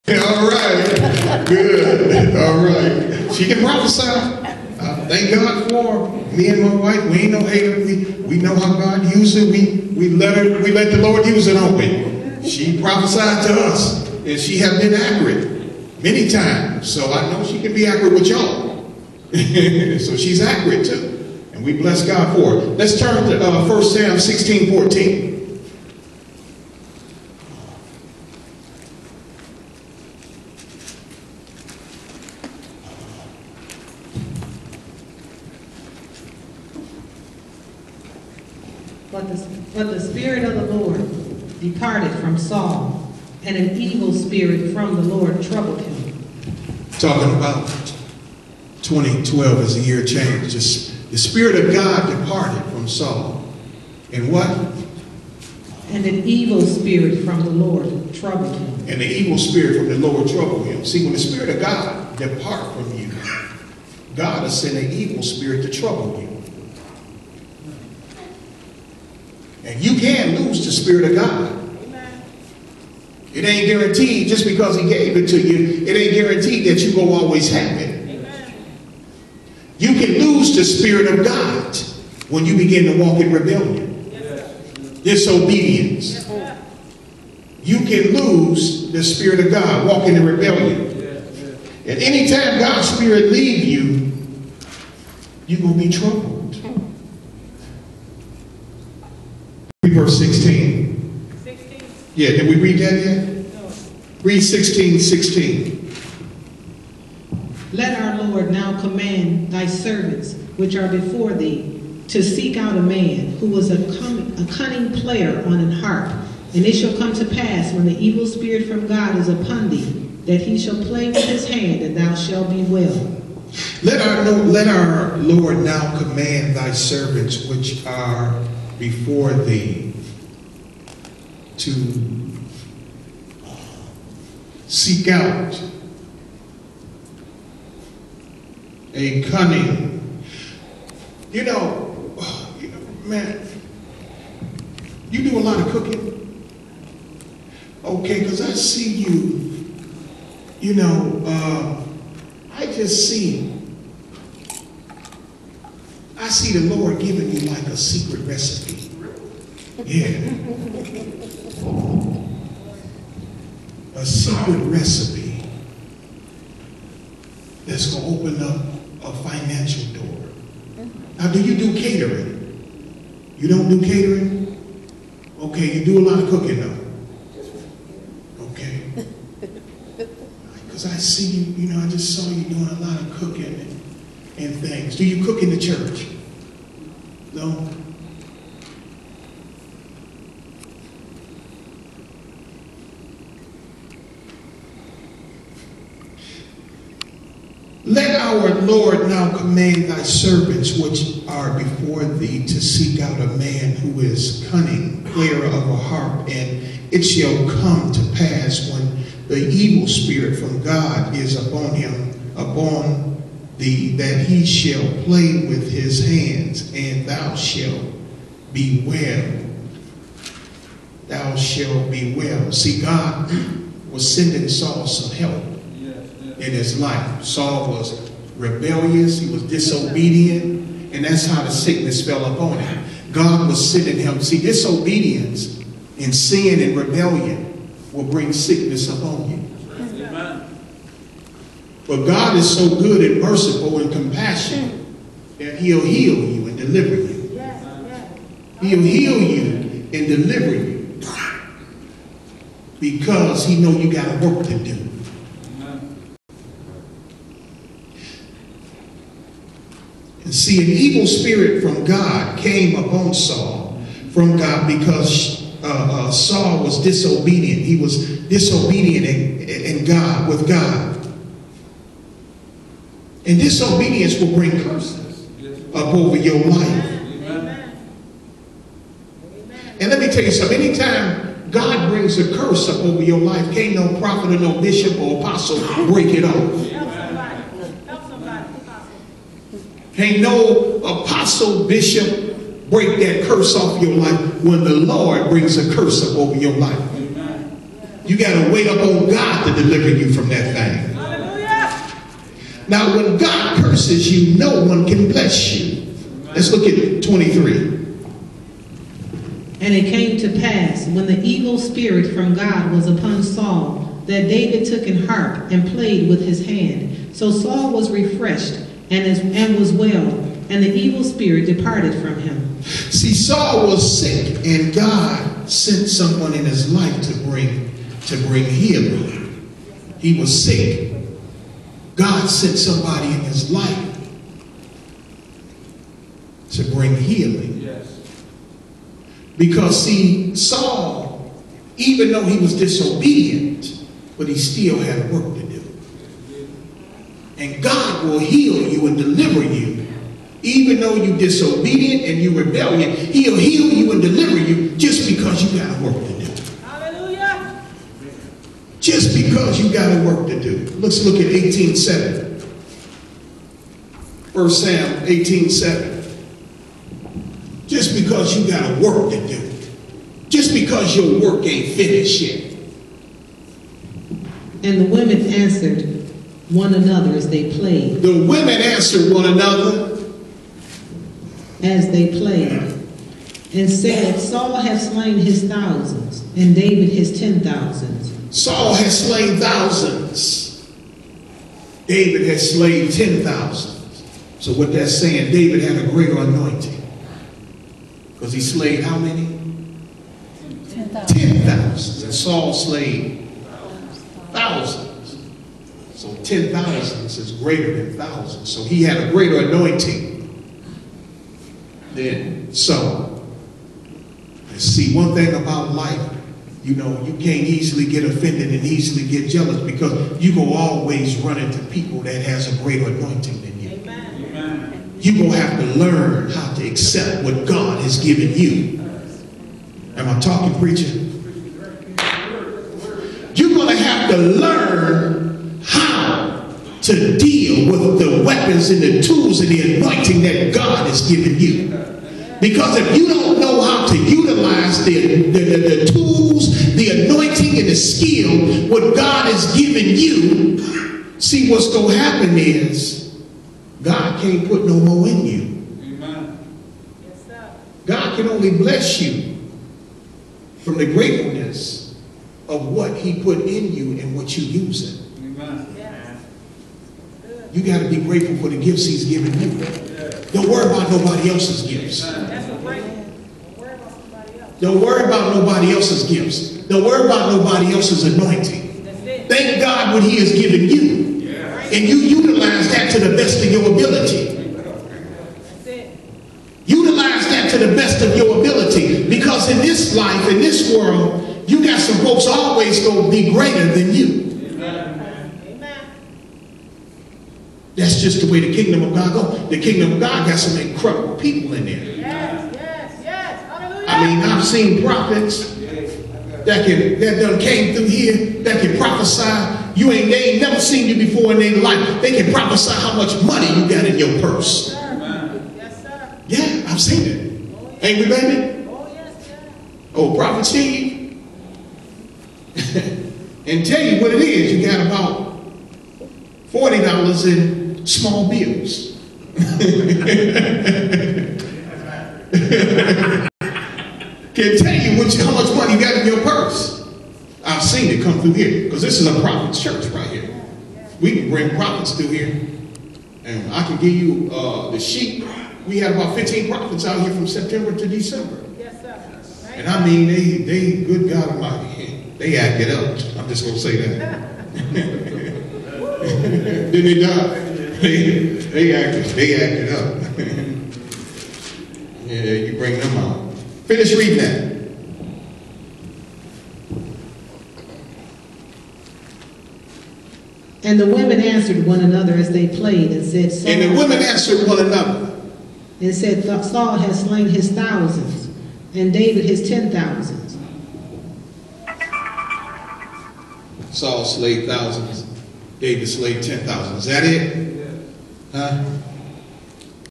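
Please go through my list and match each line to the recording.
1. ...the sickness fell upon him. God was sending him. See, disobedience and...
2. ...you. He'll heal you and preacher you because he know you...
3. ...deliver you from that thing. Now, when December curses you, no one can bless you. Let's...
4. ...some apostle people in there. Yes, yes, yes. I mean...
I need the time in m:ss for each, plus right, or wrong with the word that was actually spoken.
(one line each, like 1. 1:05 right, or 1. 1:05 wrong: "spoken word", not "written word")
1. 3:51 right
2. 4:06 wrong: "deliver", not "preacher"
3. 4:59 wrong: "God", not "December"
4. 8:20 wrong: "incredible", not "apostle".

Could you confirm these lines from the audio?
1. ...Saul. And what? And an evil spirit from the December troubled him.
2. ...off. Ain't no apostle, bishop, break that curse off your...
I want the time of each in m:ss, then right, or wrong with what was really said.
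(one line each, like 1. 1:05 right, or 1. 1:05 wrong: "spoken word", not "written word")
1. 0:52 wrong: "Lord", not "December"
2. 4:46 right.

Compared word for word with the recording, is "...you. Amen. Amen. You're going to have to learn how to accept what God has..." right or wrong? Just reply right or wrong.
right.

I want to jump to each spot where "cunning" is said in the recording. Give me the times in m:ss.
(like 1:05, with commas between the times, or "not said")
1:54, 2:19, 3:24.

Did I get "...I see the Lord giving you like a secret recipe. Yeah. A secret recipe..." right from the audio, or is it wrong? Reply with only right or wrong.
right.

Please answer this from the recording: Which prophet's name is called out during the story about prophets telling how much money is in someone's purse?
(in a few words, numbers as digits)
Prophet Steve.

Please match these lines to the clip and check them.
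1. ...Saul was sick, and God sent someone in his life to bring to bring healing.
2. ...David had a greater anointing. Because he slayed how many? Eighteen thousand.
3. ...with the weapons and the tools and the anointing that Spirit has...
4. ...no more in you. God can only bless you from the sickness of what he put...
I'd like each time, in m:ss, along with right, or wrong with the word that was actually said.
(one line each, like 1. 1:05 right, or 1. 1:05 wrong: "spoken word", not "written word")
1. 5:23 right
2. 6:35 wrong: "Ten", not "Eighteen"
3. 7:17 wrong: "God", not "Spirit"
4. 7:34 wrong: "gratefulness", not "sickness".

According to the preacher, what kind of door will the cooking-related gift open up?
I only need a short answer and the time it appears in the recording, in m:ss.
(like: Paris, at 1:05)
A financial door, at 2:49.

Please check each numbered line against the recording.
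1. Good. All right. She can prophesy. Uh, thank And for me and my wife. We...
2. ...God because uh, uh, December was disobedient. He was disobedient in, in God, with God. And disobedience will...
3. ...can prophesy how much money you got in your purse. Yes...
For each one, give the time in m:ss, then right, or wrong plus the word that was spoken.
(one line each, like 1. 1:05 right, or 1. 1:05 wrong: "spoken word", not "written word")
1. 0:01 wrong: "God", not "And"
2. 4:24 wrong: "Saul", not "December"
3. 8:32 right.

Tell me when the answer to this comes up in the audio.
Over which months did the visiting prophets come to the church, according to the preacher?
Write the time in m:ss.
9:07.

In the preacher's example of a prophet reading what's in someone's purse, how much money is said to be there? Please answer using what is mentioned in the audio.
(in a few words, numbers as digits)
$40.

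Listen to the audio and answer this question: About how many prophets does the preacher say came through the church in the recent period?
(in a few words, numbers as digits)
15.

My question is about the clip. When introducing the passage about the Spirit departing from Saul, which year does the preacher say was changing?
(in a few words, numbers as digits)
2012.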